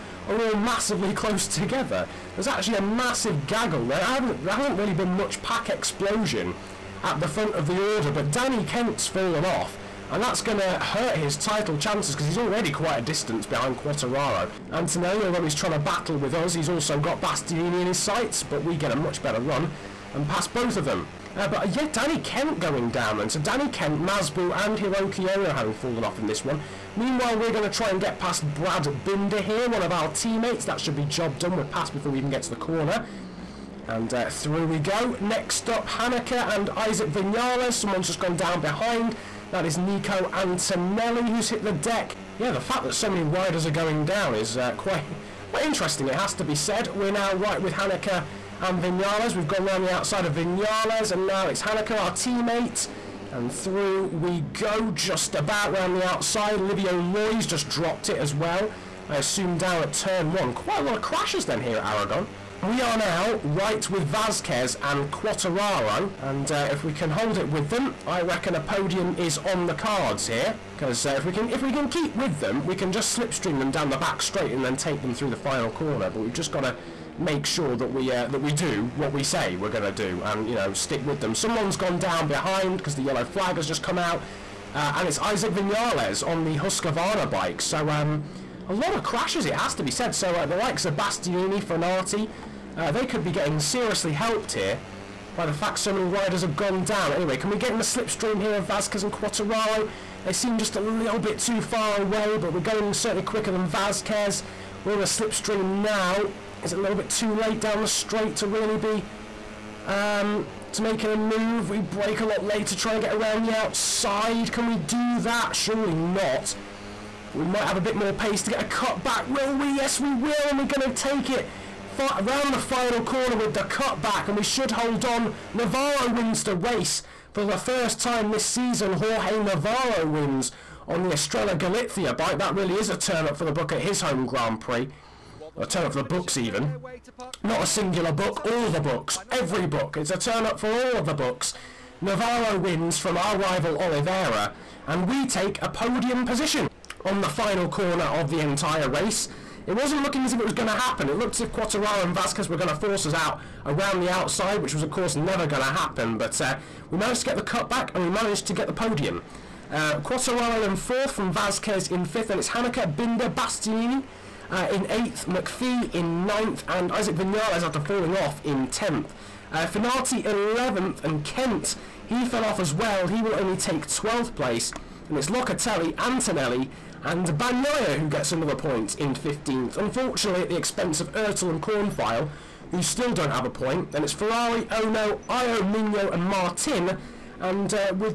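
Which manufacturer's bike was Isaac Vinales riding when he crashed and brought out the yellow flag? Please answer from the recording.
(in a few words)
Husqvarna.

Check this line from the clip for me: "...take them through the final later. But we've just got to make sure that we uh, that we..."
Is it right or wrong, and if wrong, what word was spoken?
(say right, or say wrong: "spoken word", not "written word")
wrong: "corner", not "later".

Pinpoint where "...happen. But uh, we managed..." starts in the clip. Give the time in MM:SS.
02:35.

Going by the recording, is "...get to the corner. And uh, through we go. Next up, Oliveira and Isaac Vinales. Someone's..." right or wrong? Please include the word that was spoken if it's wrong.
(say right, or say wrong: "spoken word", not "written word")
wrong: "Hanika", not "Oliveira".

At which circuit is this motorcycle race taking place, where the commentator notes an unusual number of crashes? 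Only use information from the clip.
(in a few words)
Aragon.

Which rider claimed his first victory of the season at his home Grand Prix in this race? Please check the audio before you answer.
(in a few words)
Jorge Navarro.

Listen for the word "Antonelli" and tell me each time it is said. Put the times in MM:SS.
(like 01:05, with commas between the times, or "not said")
00:14, 00:40, 02:55.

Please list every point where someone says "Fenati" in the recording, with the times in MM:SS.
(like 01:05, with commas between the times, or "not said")
01:31, 02:49.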